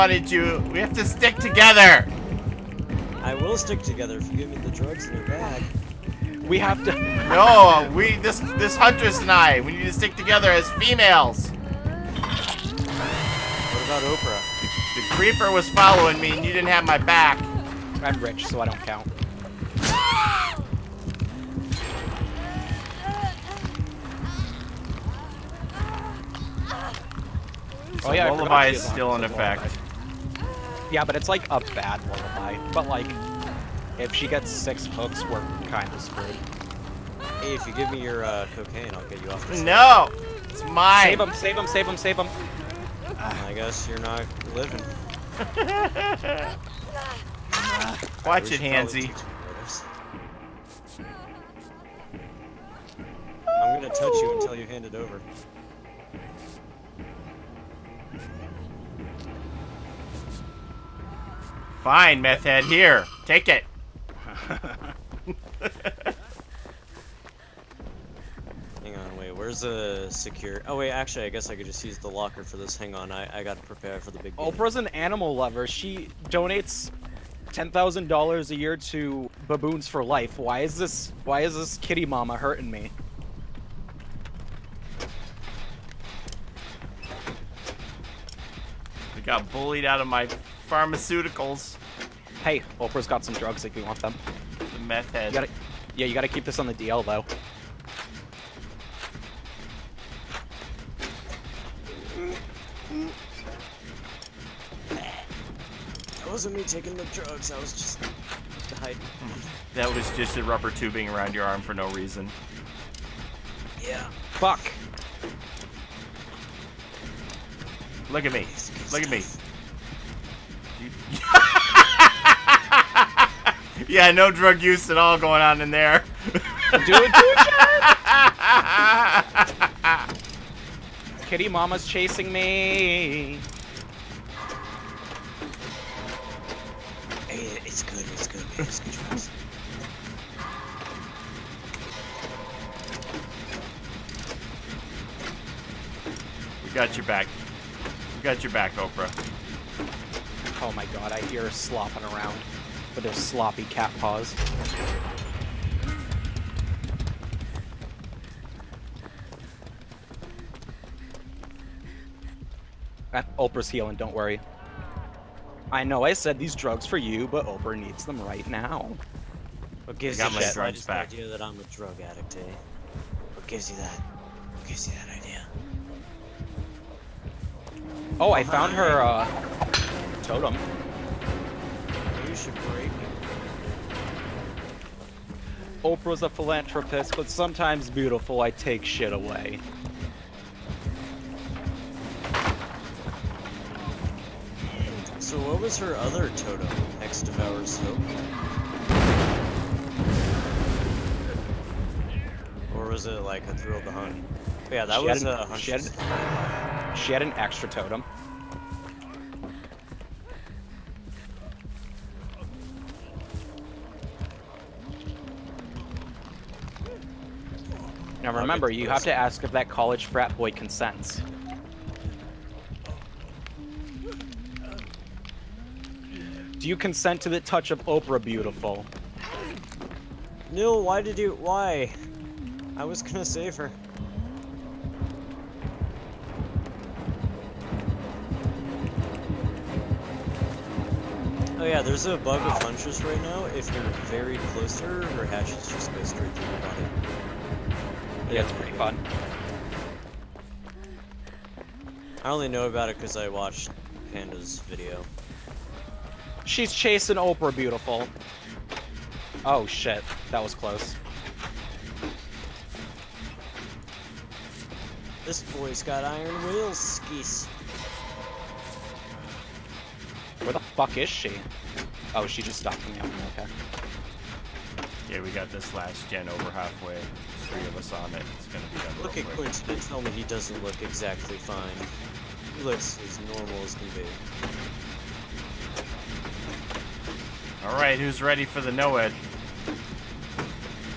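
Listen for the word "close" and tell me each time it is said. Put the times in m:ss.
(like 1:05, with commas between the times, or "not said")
4:04, 4:20.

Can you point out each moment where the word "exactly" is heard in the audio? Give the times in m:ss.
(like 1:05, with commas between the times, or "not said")
4:40.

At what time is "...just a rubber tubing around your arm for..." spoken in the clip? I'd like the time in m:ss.
1:50.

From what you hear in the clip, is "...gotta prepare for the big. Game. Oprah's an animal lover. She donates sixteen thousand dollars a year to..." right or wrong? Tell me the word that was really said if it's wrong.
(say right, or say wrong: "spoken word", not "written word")
wrong: "ten", not "sixteen".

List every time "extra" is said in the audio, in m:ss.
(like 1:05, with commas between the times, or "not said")
3:27.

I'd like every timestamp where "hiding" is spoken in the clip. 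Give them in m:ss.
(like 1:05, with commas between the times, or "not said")
1:48.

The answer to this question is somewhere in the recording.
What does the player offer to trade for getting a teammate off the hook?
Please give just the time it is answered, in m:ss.
0:38.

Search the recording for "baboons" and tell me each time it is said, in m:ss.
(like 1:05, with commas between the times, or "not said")
1:19.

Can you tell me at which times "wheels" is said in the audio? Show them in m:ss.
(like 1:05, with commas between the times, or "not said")
4:26.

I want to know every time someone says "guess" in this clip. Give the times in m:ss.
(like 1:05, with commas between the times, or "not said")
0:43, 1:11.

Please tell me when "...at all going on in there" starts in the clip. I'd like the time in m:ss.
2:04.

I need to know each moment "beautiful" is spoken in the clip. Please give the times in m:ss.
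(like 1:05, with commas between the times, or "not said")
3:07, 3:48, 4:17.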